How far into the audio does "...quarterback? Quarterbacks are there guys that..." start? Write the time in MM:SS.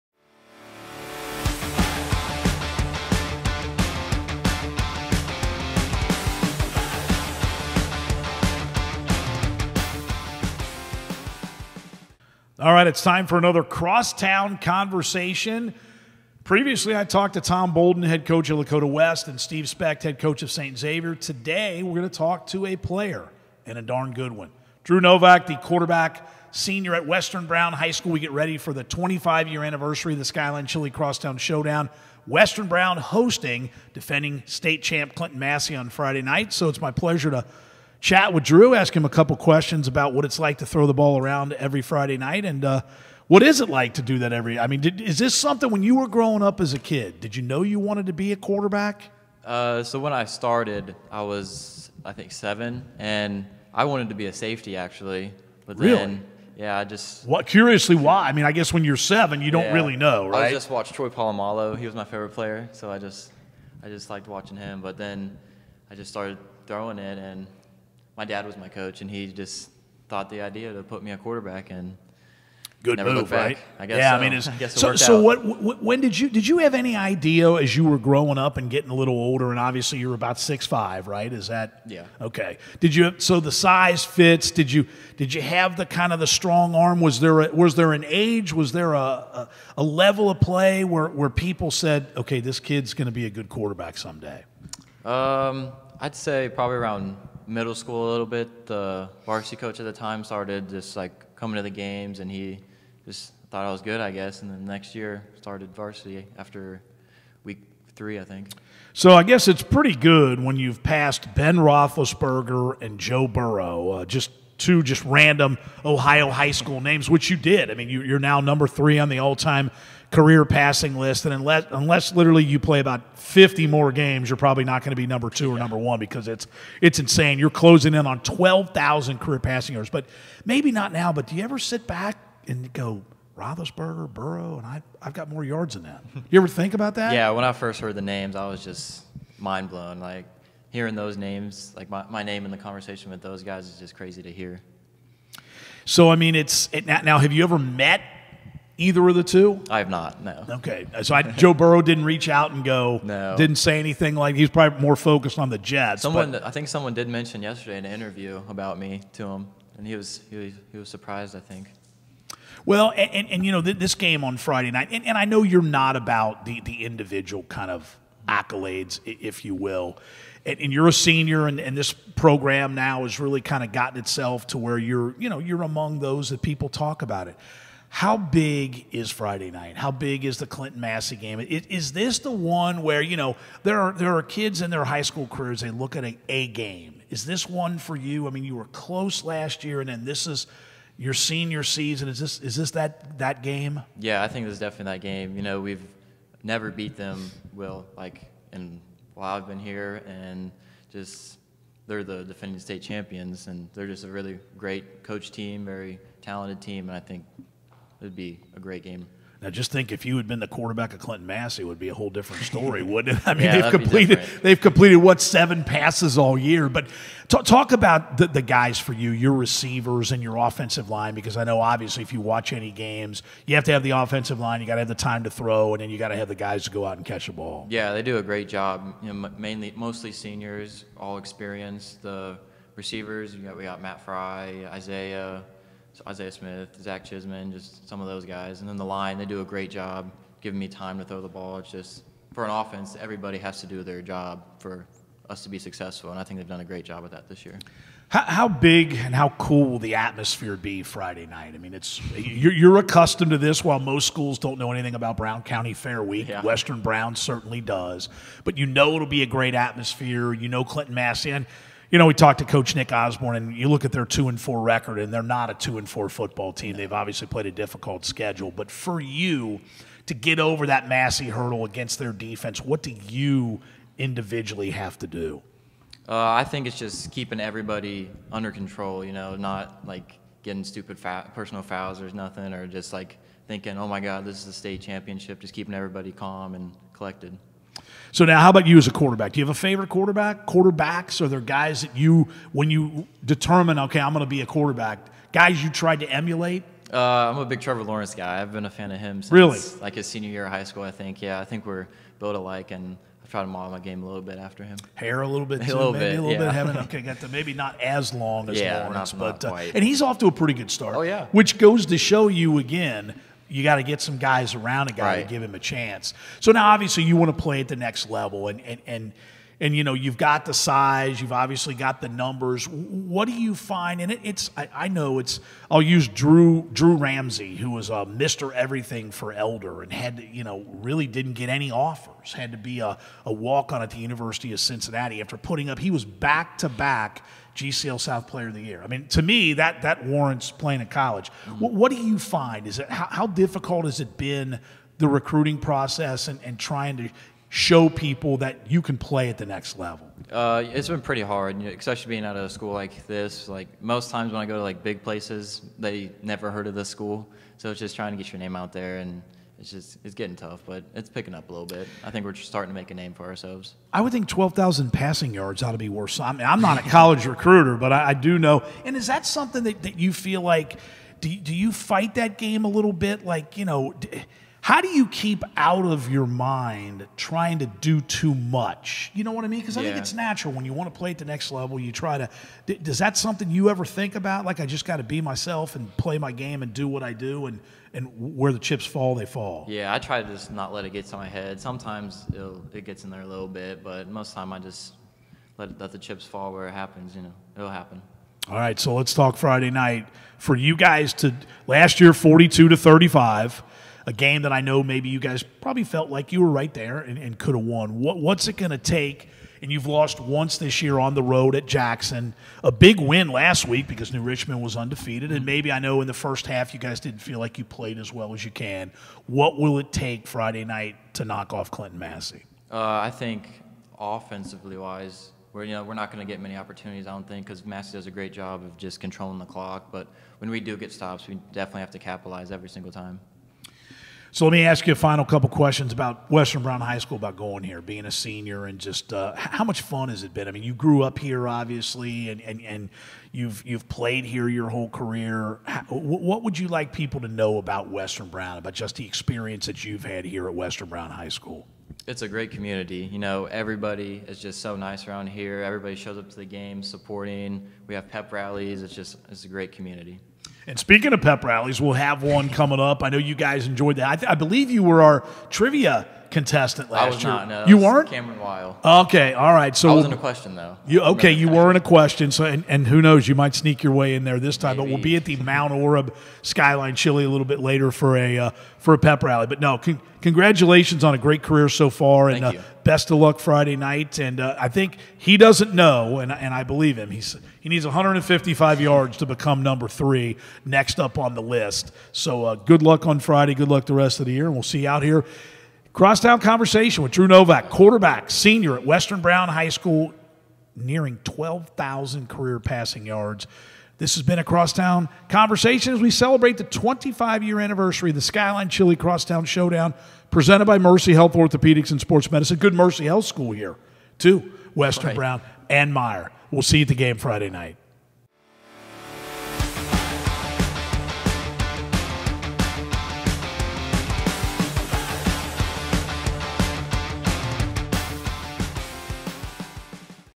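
04:49.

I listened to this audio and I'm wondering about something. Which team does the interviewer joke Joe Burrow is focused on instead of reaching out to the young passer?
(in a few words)
the Jets.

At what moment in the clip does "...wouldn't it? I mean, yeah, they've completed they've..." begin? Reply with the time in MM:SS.
03:32.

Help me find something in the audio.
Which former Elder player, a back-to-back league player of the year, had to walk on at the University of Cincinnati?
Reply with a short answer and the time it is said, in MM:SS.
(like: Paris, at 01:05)
Drew Ramsey, at 05:26.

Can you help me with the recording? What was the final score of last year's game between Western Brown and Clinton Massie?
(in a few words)
42-35.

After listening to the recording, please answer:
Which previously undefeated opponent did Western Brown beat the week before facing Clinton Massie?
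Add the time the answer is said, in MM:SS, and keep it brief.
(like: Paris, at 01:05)
New Richmond, at 06:54.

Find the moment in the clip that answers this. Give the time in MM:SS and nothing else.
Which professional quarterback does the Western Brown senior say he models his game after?
04:57.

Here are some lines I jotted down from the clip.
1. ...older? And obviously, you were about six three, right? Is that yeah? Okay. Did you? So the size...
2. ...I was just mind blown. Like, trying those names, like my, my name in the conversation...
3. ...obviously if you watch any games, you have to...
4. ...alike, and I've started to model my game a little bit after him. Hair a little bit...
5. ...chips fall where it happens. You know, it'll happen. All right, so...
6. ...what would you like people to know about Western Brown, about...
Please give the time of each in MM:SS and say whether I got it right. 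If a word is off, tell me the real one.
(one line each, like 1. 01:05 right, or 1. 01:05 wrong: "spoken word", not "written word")
1. 01:19 wrong: "five", not "three"
2. 02:18 wrong: "hearing", not "trying"
3. 03:41 right
4. 05:02 wrong: "tried", not "started"
5. 06:35 right
6. 07:25 right.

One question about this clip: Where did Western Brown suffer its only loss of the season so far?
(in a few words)
Jackson.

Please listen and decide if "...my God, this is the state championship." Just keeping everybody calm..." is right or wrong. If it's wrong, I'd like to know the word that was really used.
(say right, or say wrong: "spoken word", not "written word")
right.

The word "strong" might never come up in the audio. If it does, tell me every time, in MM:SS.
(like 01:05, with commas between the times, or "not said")
01:26.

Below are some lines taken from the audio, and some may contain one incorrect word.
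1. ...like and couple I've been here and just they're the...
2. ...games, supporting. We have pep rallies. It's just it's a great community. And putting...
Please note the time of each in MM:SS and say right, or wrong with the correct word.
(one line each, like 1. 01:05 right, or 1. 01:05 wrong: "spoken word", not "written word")
1. 03:17 wrong: "while", not "couple"
2. 07:36 wrong: "speaking", not "putting".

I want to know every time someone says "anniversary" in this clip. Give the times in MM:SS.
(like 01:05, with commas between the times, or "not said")
00:29, 08:27.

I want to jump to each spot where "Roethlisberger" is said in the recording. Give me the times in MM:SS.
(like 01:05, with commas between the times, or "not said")
01:51, 02:13.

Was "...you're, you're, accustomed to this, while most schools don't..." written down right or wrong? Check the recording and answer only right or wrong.
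right.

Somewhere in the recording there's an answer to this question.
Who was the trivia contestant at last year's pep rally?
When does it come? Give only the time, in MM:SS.
07:48.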